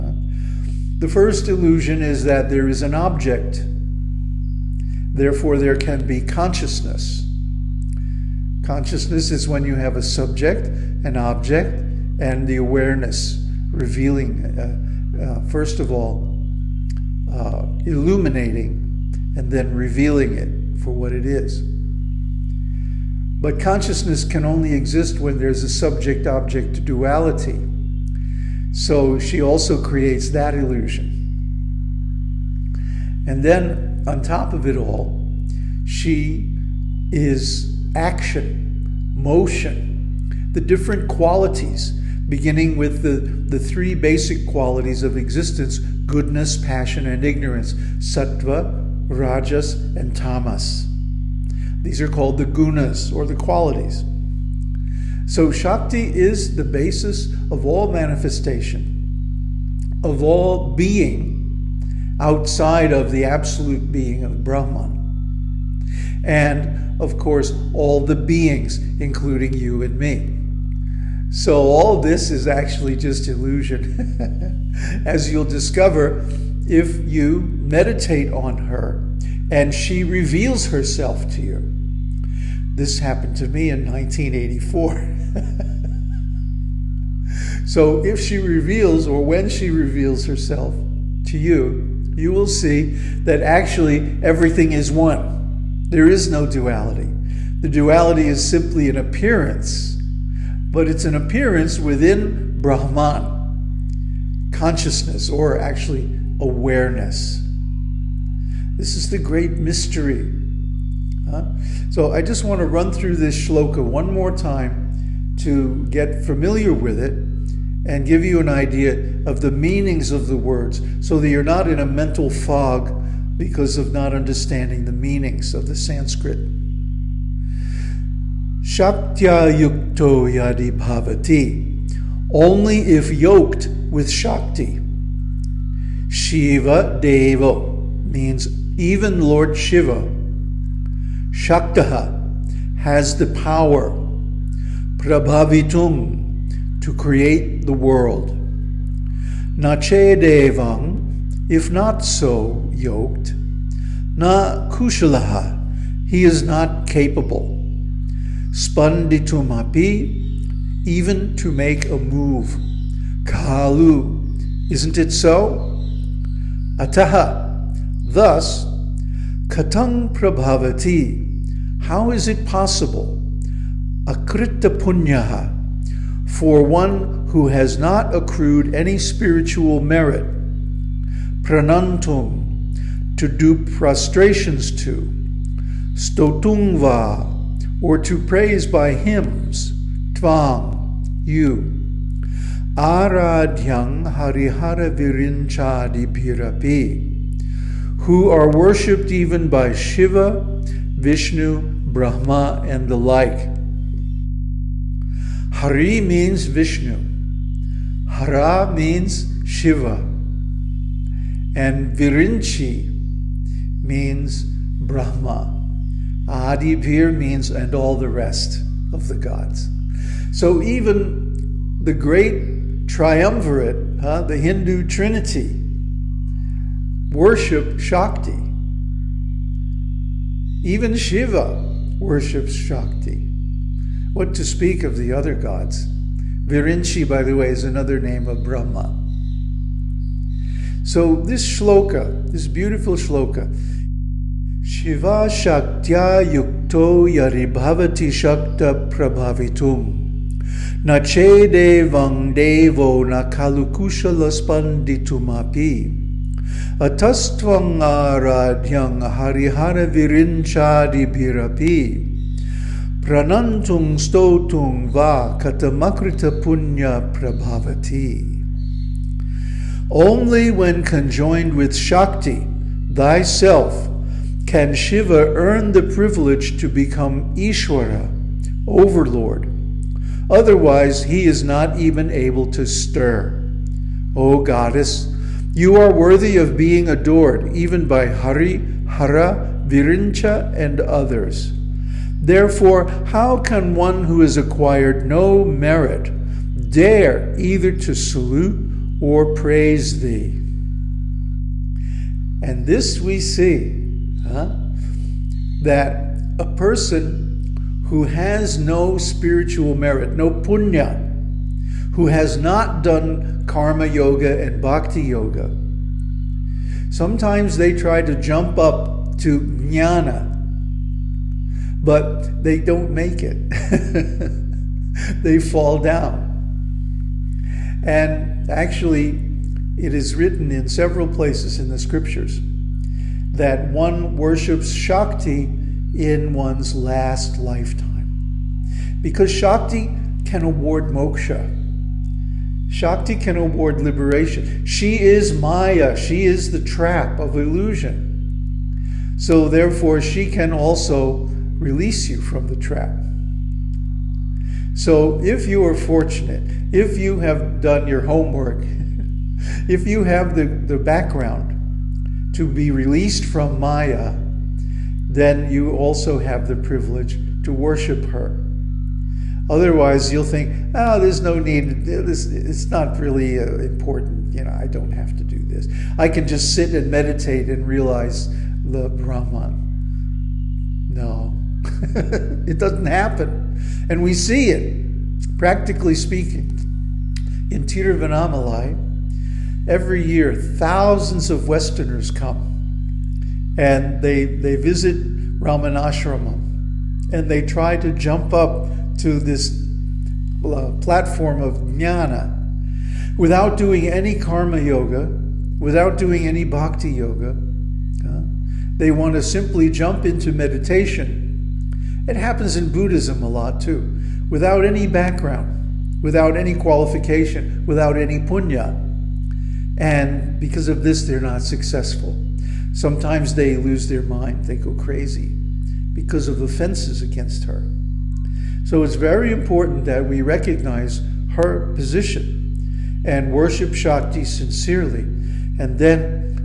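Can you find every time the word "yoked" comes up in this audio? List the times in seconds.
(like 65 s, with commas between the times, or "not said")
133 s, 152 s.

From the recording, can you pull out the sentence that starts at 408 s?
They want to simply jump into meditation.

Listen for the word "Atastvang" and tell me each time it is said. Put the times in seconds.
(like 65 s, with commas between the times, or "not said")
256 s.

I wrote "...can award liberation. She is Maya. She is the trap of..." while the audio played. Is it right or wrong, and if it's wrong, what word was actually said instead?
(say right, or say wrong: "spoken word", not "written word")
right.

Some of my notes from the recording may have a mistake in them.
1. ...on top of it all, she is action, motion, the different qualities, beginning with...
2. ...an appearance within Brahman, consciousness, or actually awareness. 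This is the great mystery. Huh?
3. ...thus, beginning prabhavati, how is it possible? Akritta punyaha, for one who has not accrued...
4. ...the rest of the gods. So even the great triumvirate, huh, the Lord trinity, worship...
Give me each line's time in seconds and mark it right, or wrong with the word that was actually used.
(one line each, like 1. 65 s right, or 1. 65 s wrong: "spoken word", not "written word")
1. 34 s right
2. 101 s right
3. 168 s wrong: "katang", not "beginning"
4. 217 s wrong: "Hindu", not "Lord".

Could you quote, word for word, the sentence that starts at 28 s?
So she also creates that illusion.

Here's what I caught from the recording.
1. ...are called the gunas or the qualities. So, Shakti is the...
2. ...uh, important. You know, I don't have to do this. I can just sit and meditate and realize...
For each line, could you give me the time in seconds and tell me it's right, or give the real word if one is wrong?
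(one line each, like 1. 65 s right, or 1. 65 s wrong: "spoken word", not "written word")
1. 52 s right
2. 373 s right.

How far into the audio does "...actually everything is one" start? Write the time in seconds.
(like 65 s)
93 s.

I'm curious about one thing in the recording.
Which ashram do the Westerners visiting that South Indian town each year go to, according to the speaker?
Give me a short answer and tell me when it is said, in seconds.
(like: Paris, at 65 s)
Ramanashramam, at 395 s.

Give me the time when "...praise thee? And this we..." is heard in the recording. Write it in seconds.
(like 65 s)
299 s.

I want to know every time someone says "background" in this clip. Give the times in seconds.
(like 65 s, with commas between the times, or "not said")
360 s, 414 s.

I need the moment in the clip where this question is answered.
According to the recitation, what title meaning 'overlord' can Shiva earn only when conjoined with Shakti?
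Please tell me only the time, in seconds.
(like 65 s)
277 s.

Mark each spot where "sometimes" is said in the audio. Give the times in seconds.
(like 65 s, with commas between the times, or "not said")
316 s, 422 s.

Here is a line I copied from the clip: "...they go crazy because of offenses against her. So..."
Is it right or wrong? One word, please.
right.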